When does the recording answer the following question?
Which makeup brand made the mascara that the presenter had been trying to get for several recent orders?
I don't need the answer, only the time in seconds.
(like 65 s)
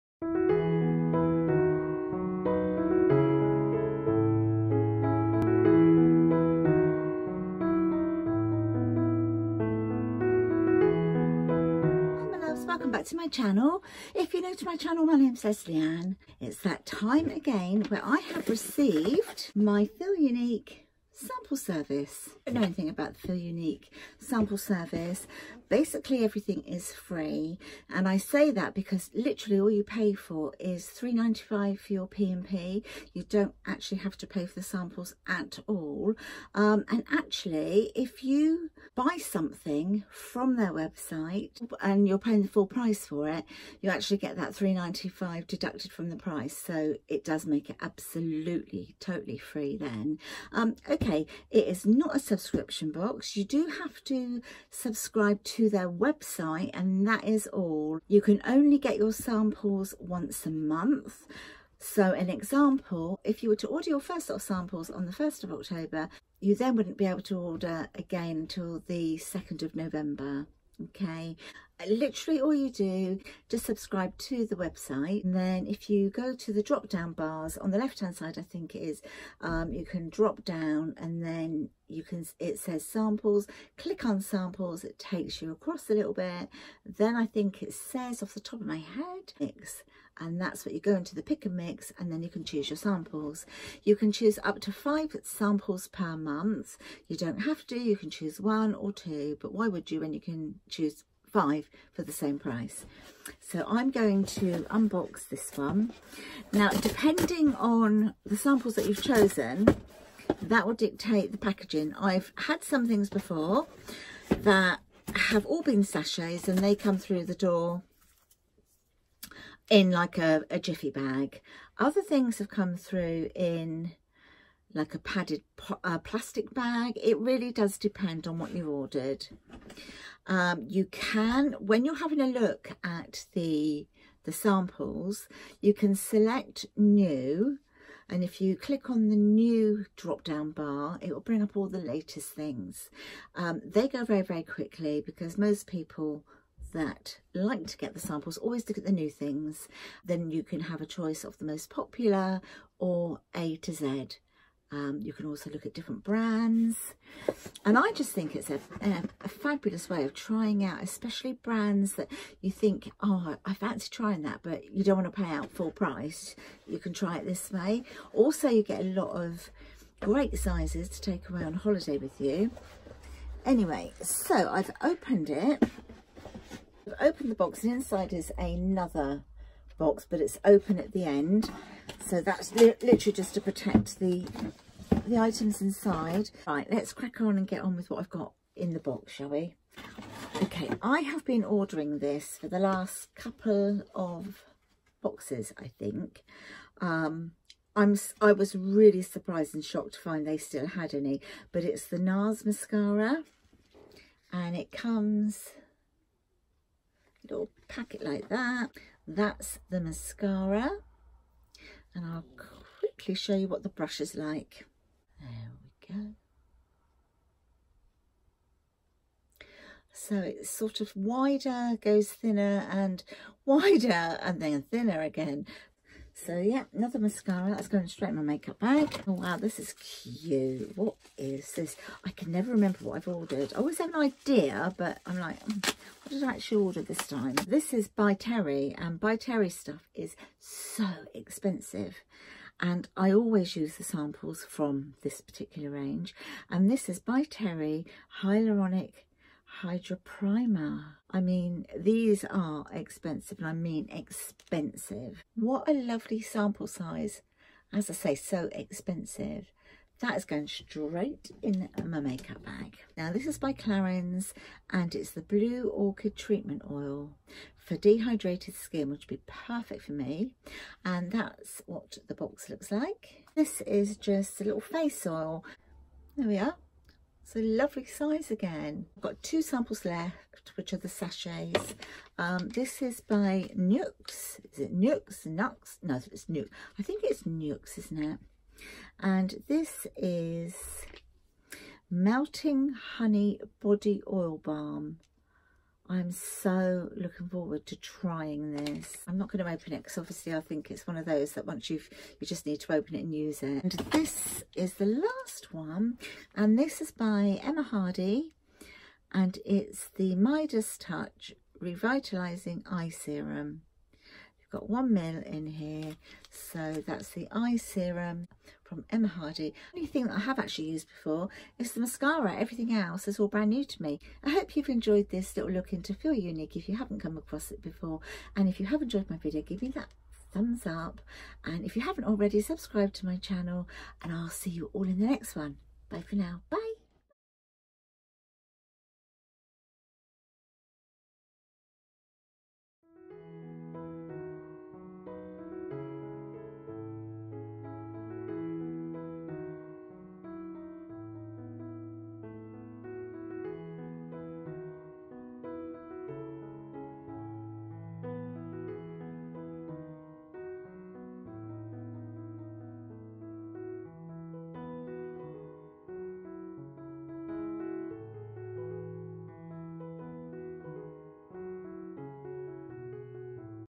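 201 s.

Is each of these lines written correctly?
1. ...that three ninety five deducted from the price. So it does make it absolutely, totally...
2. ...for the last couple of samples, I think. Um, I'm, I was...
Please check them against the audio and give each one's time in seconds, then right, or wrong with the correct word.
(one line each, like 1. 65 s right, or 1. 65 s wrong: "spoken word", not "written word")
1. 44 s right
2. 192 s wrong: "boxes", not "samples".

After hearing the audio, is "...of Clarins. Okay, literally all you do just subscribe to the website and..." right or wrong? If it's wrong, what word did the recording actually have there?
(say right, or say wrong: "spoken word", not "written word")
wrong: "November", not "Clarins".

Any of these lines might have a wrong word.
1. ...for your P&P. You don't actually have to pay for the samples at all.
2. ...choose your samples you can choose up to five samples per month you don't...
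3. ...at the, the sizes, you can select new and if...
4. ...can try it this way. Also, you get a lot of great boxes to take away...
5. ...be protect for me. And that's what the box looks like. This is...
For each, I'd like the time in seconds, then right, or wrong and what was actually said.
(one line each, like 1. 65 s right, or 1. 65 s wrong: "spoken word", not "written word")
1. 31 s right
2. 92 s right
3. 132 s wrong: "samples", not "sizes"
4. 166 s wrong: "sizes", not "boxes"
5. 269 s wrong: "perfect", not "protect".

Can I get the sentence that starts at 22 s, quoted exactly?
I don't know anything about the Feel Unique sample service.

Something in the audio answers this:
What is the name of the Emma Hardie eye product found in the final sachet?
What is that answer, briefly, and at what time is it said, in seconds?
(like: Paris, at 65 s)
Midas Touch Revitalising Eye Serum, at 310 s.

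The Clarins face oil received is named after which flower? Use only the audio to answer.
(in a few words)
Blue Orchid.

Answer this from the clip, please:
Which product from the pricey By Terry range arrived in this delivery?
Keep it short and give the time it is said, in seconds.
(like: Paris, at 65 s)
Hyaluronic Hydra Primer, at 248 s.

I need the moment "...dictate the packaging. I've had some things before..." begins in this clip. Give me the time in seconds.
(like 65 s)
110 s.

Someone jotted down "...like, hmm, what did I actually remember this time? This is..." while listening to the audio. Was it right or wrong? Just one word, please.
wrong.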